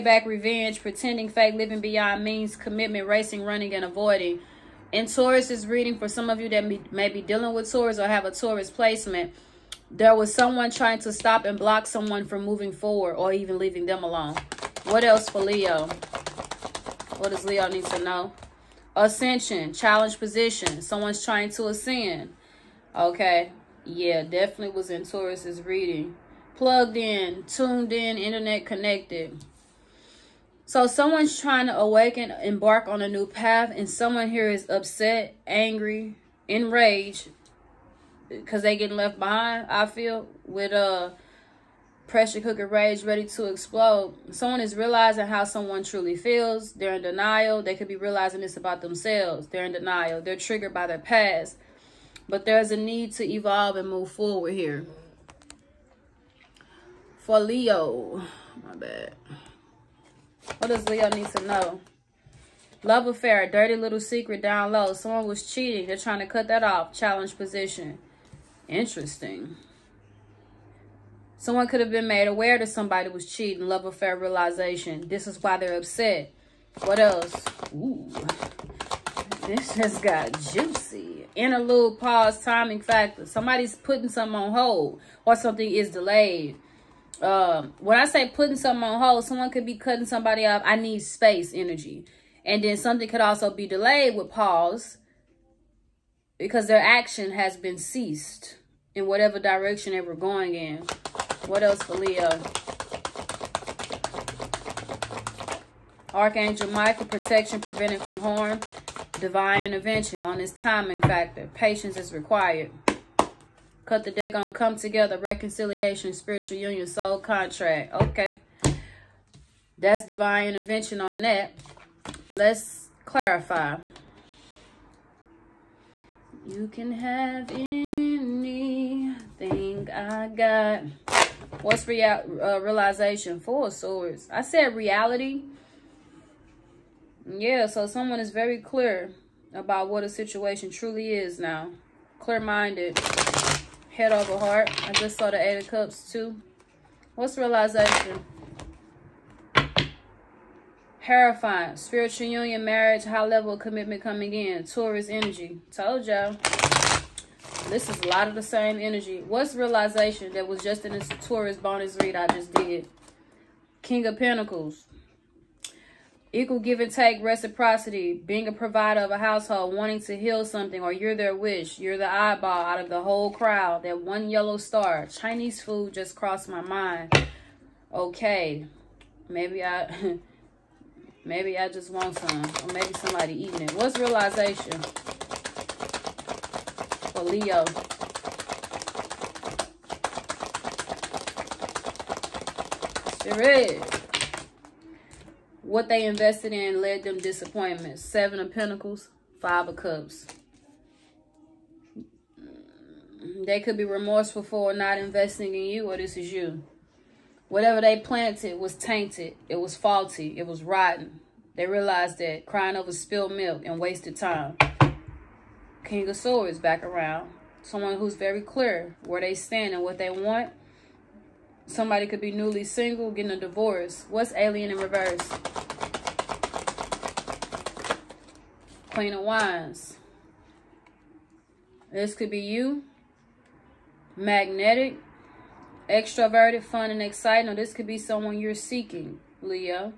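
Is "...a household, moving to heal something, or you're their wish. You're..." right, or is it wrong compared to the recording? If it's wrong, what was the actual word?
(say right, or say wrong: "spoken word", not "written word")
wrong: "wanting", not "moving".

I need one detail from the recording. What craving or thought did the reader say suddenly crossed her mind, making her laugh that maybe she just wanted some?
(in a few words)
Chinese food.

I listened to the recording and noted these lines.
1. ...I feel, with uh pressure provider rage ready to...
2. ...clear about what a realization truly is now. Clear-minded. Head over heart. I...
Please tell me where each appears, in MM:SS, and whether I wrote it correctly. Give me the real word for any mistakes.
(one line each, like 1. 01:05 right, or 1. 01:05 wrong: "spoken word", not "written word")
1. 00:39 wrong: "cooker", not "provider"
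2. 02:18 wrong: "situation", not "realization".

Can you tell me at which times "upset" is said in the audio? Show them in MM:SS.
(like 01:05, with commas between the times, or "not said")
00:34, 01:15.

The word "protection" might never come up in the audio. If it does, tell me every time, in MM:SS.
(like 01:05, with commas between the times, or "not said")
01:47.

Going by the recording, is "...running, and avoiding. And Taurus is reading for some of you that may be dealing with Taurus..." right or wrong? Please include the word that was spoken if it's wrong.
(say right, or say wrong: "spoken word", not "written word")
right.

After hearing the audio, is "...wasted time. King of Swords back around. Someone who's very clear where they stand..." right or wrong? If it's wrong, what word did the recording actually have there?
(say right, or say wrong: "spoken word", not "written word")
right.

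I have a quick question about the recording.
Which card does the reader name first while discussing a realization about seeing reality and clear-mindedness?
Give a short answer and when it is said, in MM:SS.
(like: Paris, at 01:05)
Four of Swords, at 02:13.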